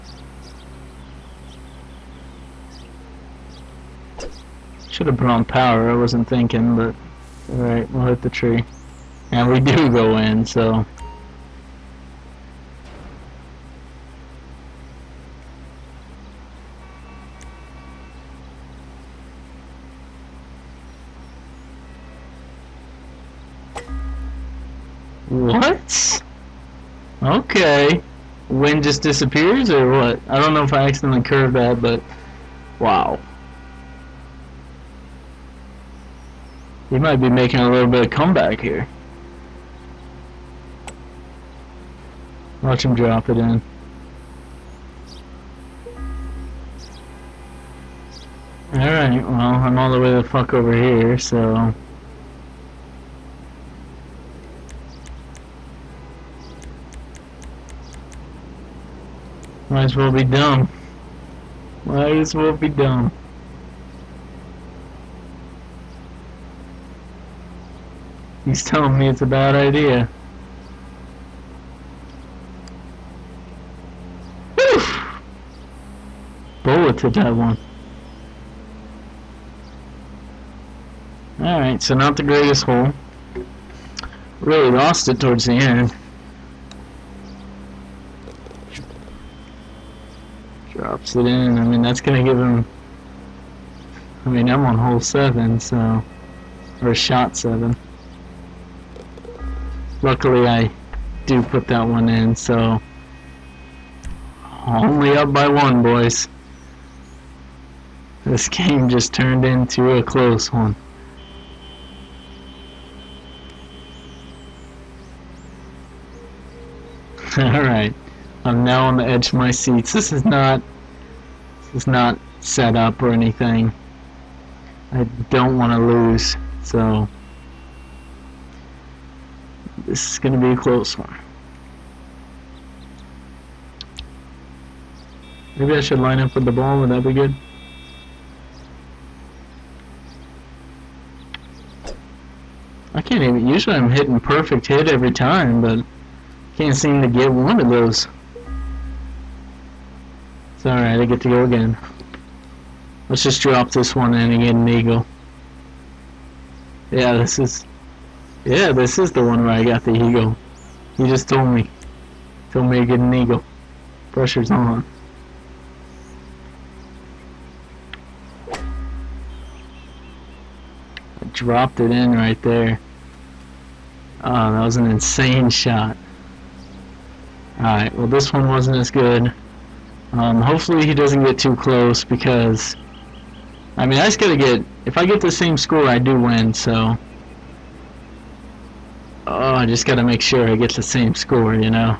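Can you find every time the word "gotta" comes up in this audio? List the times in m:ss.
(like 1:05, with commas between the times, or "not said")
3:04, 3:09.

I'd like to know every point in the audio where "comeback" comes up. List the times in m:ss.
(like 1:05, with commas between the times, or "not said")
0:38.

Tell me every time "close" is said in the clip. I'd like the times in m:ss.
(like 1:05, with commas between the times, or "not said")
1:50, 2:10, 3:01.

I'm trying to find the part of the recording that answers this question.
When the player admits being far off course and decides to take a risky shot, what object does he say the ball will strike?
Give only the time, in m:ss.
0:08.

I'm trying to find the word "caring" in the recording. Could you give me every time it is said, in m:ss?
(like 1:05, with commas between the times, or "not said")
not said.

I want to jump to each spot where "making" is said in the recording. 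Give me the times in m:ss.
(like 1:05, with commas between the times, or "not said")
0:37.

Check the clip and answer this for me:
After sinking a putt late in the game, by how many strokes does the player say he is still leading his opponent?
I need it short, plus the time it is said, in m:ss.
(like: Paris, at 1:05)
1, at 1:45.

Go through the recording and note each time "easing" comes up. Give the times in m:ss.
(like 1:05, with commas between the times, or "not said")
not said.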